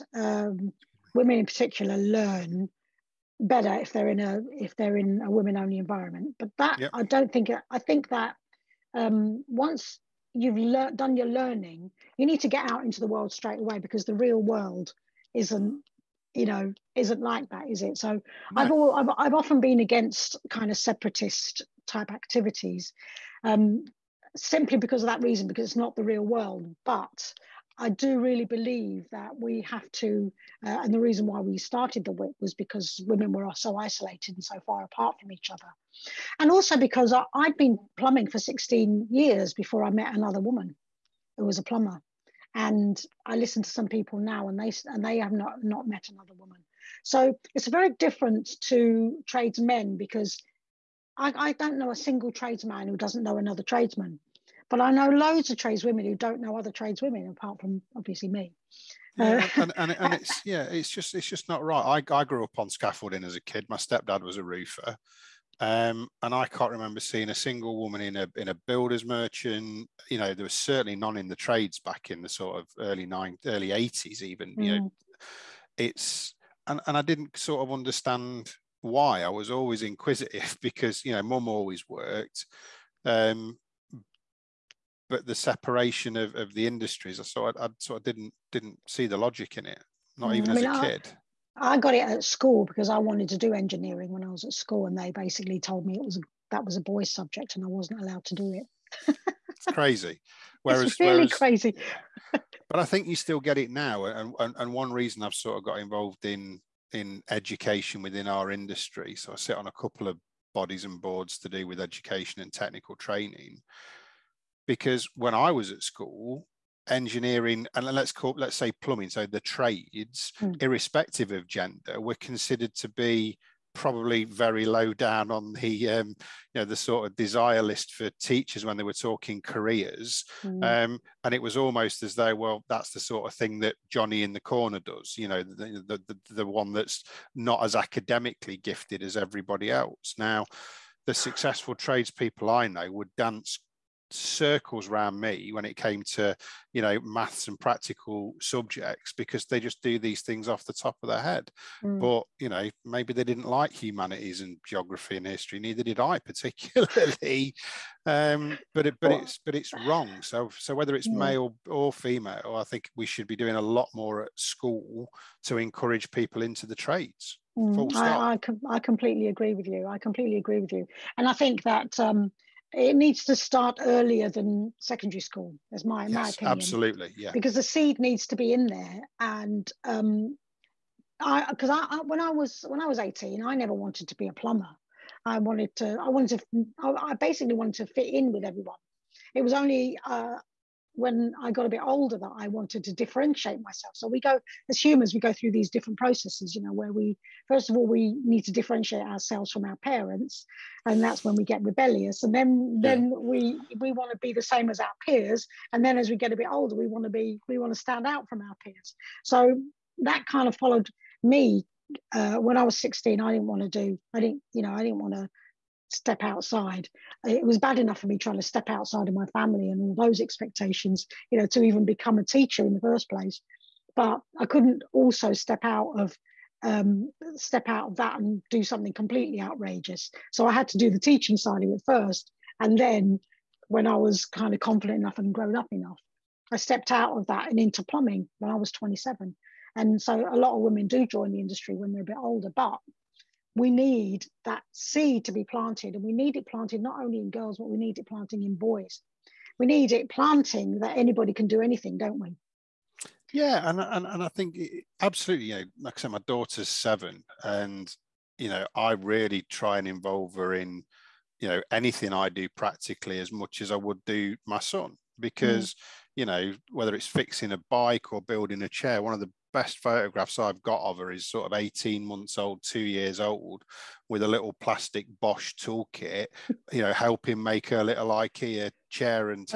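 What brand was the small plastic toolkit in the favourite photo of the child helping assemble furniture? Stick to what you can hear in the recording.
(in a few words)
Bosch.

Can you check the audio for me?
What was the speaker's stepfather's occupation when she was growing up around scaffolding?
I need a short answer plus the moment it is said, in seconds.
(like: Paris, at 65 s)
Roofer, at 64 s.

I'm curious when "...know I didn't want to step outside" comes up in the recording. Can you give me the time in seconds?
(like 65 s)
214 s.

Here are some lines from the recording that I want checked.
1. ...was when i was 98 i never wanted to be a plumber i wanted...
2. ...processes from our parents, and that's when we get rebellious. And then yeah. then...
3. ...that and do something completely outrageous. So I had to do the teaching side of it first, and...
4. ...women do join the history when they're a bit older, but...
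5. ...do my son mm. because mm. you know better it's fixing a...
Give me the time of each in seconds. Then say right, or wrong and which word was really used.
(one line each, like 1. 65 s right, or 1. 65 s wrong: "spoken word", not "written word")
1. 182 s wrong: "18", not "98"
2. 199 s wrong: "ourselves", not "processes"
3. 227 s right
4. 240 s wrong: "industry", not "history"
5. 264 s wrong: "whether", not "better".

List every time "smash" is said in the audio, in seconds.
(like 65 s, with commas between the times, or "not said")
not said.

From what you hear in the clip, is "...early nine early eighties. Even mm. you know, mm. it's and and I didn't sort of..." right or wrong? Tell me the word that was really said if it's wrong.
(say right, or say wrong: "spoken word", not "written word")
right.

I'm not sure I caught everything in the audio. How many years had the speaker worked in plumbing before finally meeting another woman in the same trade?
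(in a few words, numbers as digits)
16.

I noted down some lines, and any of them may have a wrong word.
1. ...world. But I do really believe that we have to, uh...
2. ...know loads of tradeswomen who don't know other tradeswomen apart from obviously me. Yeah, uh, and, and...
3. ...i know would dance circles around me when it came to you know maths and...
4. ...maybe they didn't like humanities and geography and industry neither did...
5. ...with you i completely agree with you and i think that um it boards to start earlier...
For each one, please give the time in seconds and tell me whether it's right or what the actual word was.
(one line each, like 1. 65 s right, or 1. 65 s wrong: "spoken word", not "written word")
1. 26 s right
2. 54 s right
3. 142 s right
4. 152 s wrong: "history", not "industry"
5. 169 s wrong: "needs", not "boards".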